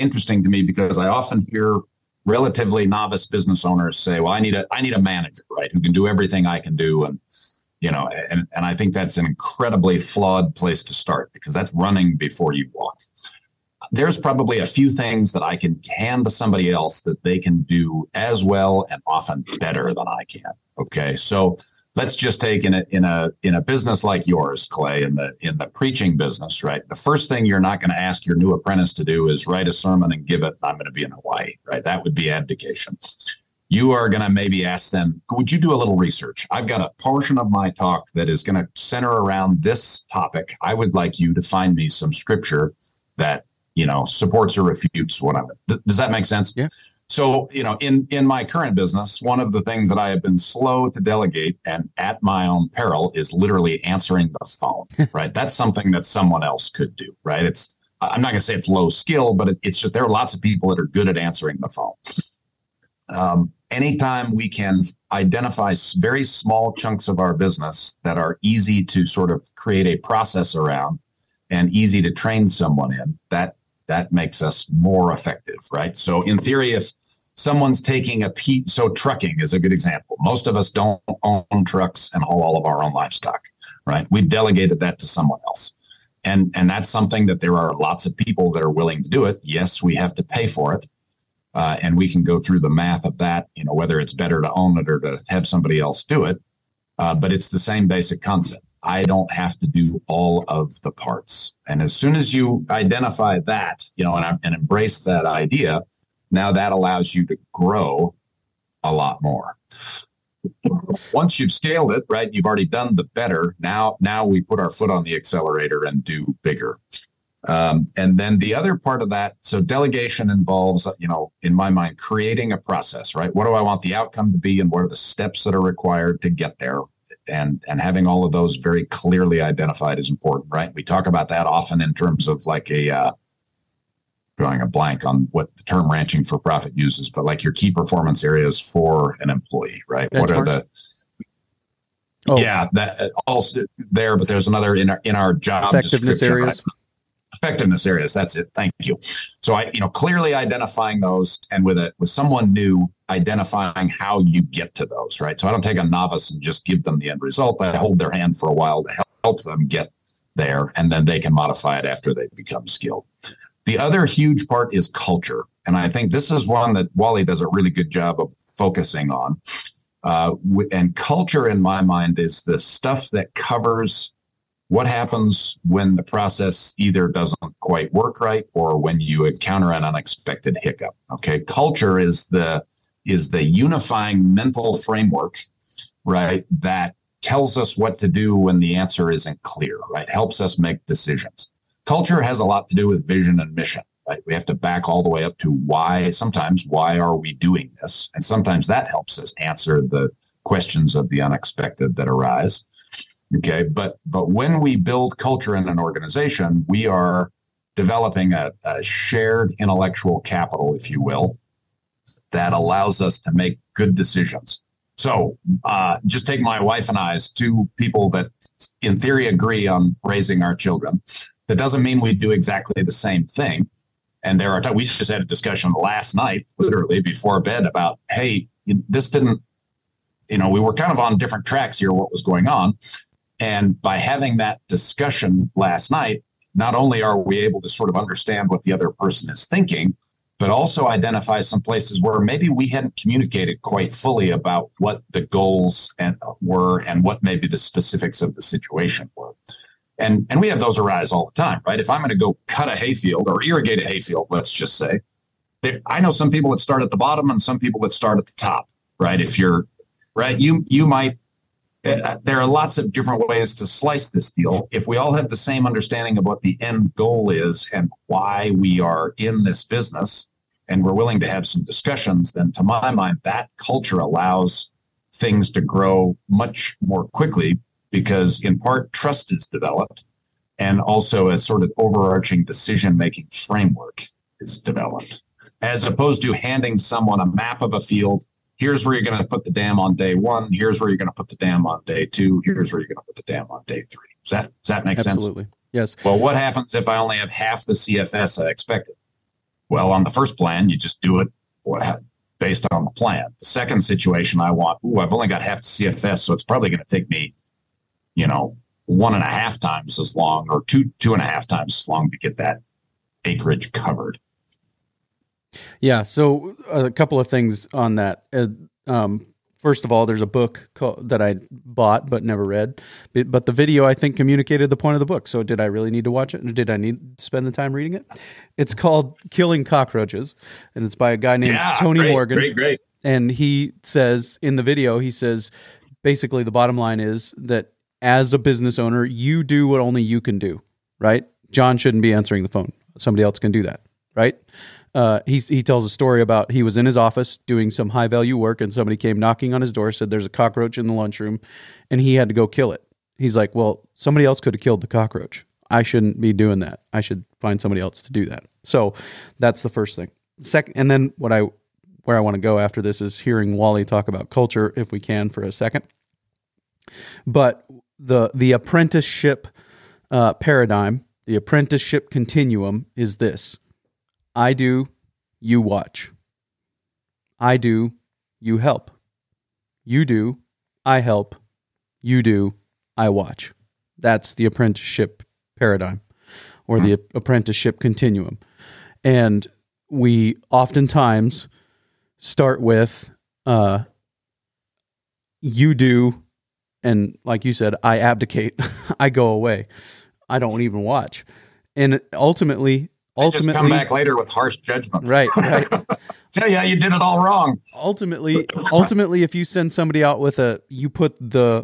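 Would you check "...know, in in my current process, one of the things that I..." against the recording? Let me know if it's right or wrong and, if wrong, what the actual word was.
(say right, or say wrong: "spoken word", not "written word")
wrong: "business", not "process".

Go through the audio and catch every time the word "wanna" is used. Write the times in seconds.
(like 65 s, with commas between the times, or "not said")
not said.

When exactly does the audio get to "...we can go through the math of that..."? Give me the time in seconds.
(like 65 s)
91 s.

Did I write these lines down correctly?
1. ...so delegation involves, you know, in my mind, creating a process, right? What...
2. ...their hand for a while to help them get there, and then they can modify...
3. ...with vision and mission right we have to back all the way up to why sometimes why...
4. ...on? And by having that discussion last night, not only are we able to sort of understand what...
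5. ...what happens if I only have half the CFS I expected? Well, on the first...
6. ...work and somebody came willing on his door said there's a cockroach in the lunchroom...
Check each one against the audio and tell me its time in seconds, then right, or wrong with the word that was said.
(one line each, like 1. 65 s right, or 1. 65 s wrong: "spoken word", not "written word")
1. 119 s right
2. 157 s right
3. 192 s right
4. 232 s right
5. 296 s right
6. 348 s wrong: "knocking", not "willing".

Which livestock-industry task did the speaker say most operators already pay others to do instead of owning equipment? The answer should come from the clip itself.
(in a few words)
Trucking.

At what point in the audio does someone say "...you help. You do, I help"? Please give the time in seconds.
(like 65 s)
378 s.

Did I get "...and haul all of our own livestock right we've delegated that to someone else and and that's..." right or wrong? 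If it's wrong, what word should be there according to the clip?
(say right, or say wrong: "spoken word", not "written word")
right.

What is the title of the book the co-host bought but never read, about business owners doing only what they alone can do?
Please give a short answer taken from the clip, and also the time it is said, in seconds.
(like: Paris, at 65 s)
Killing Cockroaches, at 329 s.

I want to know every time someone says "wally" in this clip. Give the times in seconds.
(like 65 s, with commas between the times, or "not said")
166 s, 363 s.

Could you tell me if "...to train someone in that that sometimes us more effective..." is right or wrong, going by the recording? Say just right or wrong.
wrong.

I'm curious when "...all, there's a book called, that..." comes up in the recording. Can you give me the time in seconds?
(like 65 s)
319 s.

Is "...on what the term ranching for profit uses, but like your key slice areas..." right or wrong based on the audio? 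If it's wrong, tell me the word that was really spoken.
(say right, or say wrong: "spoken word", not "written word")
wrong: "performance", not "slice".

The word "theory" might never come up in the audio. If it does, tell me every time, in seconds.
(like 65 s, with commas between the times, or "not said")
76 s, 218 s.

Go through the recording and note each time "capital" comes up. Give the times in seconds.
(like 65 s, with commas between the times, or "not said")
210 s.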